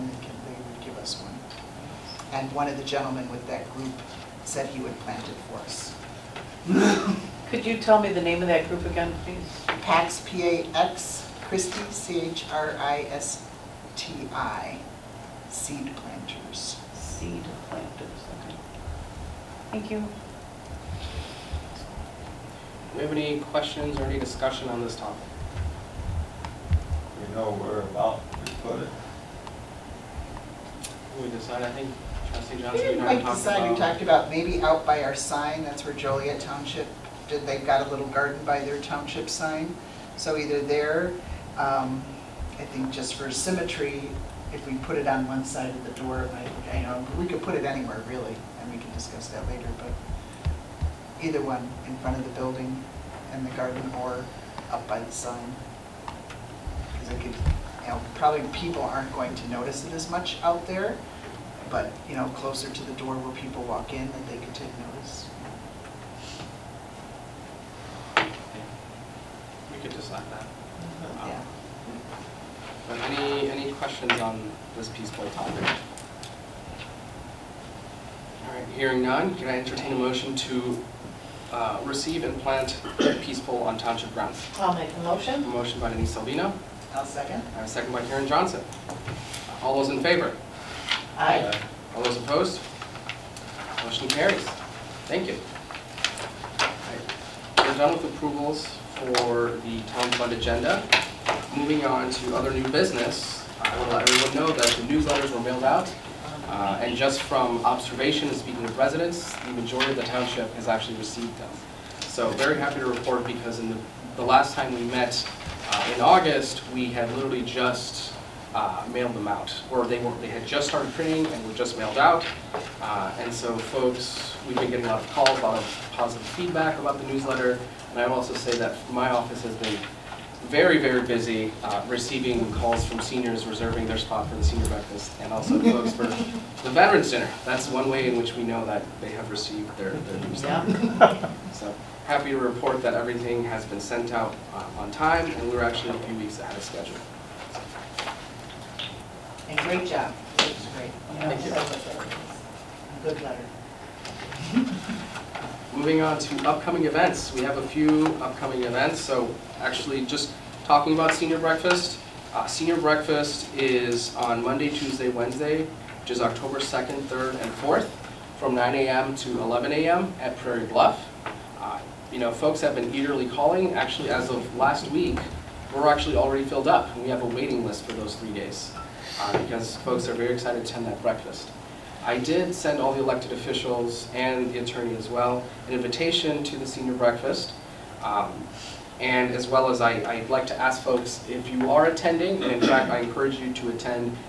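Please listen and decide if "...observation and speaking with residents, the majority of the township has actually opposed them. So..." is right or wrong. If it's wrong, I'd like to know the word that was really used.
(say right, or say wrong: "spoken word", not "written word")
wrong: "received", not "opposed".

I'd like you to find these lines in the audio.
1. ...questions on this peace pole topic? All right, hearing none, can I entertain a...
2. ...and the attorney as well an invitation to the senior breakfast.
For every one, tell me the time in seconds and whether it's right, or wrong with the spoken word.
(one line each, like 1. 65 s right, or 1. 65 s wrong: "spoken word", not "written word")
1. 73 s right
2. 184 s right.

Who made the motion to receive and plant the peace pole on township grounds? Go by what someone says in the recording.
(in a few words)
Denise Salvino.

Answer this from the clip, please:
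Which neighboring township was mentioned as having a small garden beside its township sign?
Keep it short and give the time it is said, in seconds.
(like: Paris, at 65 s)
Joliet Township, at 35 s.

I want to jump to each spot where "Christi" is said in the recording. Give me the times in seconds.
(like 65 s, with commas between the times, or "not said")
11 s.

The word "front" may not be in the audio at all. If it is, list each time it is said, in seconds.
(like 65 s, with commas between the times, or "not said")
51 s.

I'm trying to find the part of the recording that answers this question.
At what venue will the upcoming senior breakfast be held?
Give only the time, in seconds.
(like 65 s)
170 s.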